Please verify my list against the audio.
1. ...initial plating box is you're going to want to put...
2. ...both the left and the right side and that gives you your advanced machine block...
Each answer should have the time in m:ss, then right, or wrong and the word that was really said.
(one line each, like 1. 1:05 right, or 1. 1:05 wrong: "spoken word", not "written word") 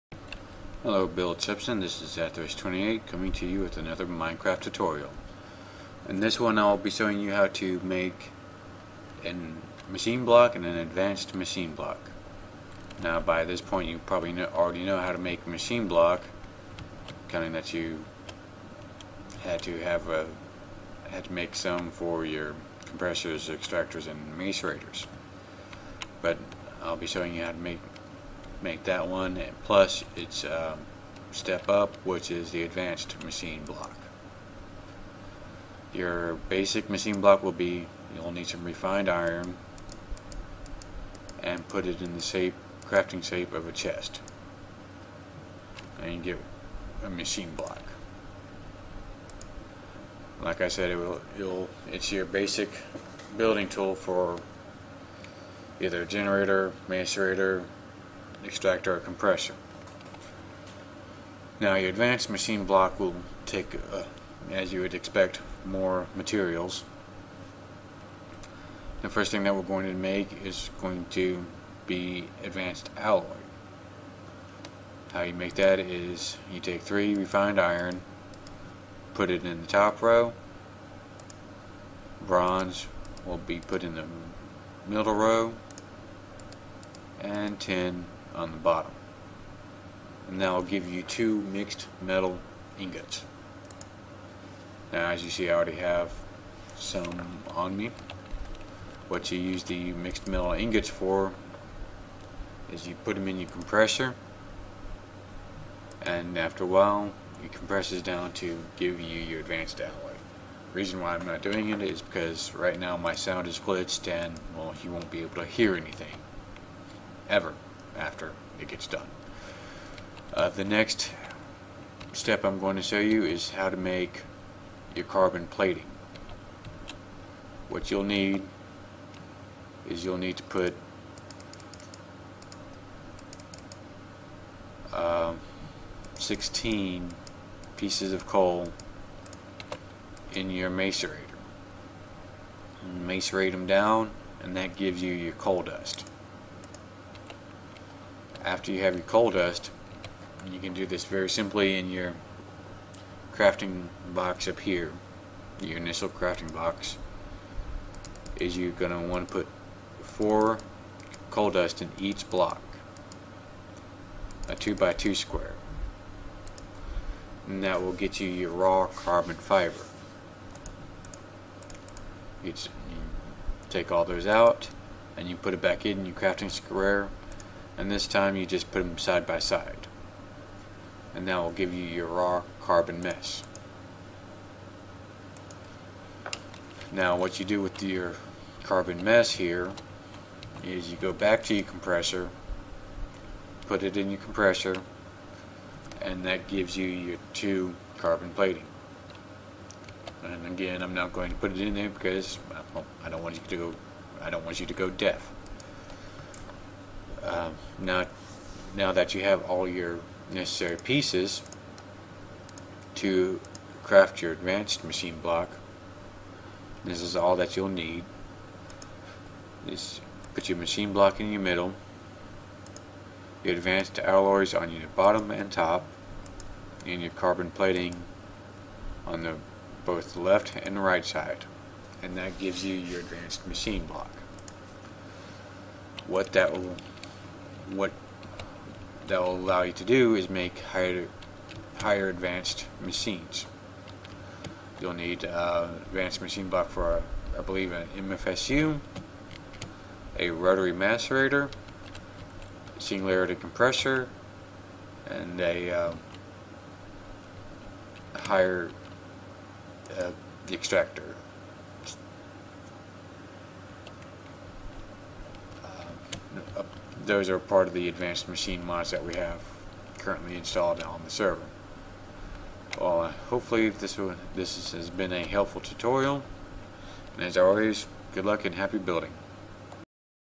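1. 2:35 wrong: "crafting", not "plating"
2. 3:49 right.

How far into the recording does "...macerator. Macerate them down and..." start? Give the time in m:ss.
2:20.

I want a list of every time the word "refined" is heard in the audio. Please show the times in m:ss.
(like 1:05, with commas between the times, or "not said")
0:38, 1:17.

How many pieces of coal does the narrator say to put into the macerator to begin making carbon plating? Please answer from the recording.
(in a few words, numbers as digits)
16.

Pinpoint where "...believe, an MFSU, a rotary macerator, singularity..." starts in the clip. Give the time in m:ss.
4:07.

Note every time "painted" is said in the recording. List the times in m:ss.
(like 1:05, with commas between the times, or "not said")
not said.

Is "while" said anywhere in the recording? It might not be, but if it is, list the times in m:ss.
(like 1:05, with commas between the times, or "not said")
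1:46.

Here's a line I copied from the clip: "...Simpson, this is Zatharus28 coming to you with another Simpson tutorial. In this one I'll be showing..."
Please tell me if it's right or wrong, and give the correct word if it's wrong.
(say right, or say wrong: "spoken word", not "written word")
wrong: "Minecraft", not "Simpson".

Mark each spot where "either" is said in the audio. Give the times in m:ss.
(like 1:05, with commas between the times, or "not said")
0:55.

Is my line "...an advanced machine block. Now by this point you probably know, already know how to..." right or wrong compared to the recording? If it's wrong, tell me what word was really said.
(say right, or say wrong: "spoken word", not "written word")
right.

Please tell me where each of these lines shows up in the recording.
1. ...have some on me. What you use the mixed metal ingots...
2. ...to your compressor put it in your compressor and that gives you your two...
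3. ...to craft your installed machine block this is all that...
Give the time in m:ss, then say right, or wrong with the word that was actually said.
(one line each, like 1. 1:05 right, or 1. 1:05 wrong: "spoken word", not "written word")
1. 1:35 right
2. 3:11 right
3. 3:32 wrong: "advanced", not "installed".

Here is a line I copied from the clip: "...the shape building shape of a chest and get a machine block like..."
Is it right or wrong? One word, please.
wrong.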